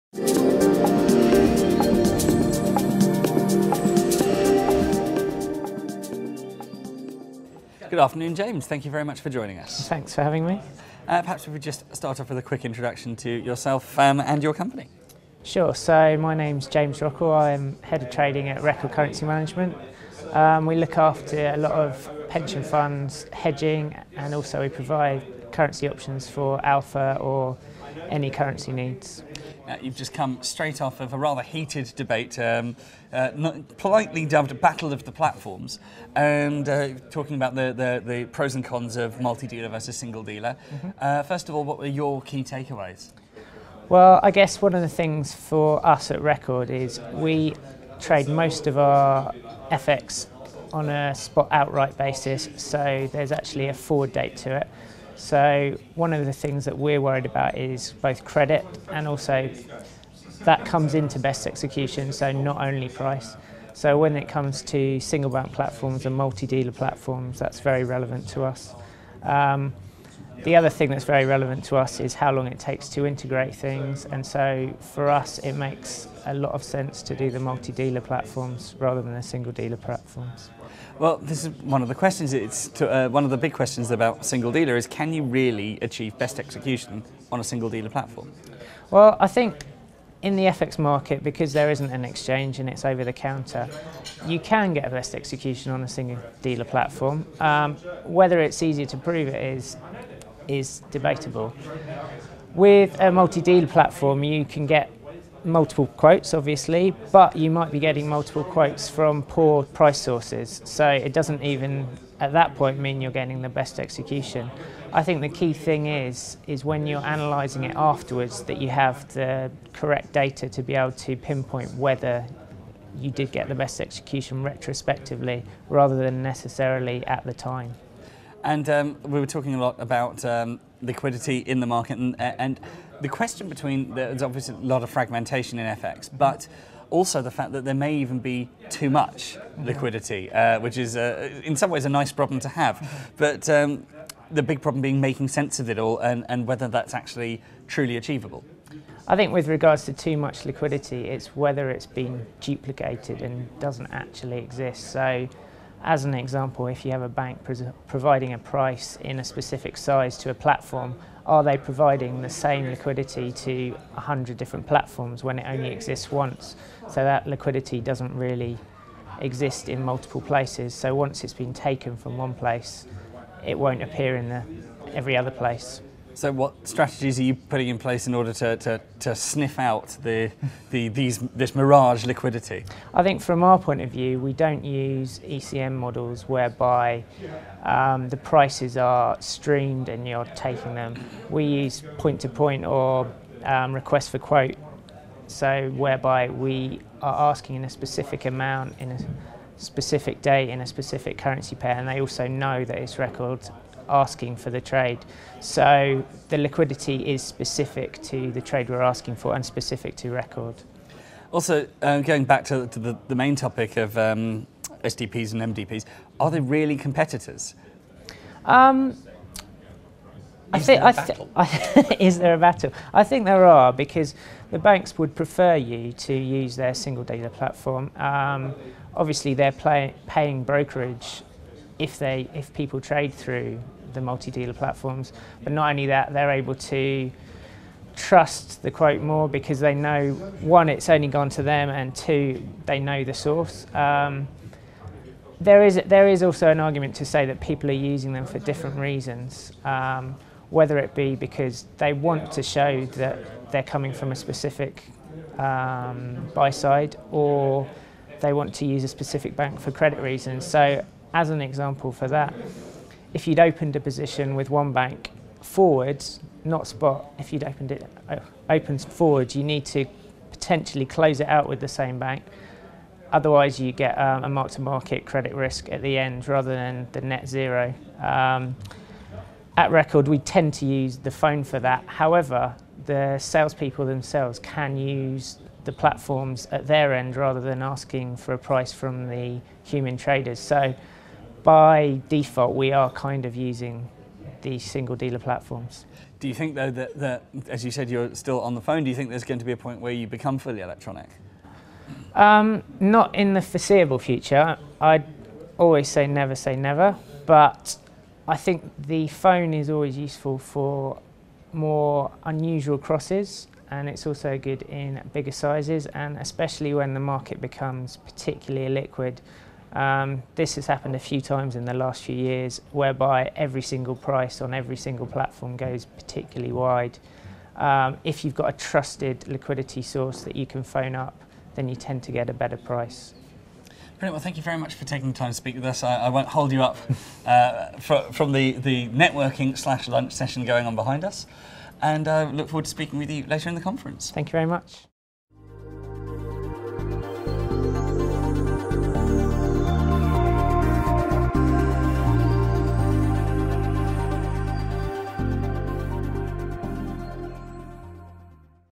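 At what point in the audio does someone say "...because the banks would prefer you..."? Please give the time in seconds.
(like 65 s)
223 s.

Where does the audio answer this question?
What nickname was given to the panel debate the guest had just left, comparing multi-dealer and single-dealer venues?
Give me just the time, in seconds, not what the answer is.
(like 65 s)
34 s.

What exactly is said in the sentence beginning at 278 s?
Um, at Record, we tend to use the phone for that.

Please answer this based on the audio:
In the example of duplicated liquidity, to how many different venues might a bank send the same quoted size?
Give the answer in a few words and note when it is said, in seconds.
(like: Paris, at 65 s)
100, at 163 s.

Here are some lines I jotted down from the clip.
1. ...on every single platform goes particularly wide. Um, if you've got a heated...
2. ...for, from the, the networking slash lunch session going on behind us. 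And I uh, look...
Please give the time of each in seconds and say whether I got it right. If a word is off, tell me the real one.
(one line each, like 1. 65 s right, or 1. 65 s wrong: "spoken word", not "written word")
1. 324 s wrong: "trusted", not "heated"
2. 337 s right.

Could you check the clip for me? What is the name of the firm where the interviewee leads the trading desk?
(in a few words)
Record Currency Management.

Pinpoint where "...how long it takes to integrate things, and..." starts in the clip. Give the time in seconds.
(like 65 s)
72 s.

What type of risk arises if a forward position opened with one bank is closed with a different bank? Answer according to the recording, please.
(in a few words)
mark-to-market credit risk.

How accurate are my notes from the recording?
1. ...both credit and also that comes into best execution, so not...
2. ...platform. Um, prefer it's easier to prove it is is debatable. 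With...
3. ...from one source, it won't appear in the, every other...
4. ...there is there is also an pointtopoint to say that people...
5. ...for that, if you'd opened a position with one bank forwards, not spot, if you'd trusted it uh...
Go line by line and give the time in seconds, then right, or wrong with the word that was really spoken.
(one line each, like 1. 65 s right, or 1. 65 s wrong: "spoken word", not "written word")
1. 58 s right
2. 96 s wrong: "whether", not "prefer"
3. 171 s wrong: "place", not "source"
4. 245 s wrong: "argument", not "pointtopoint"
5. 261 s wrong: "opened", not "trusted".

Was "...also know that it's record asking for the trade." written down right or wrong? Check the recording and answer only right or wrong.
right.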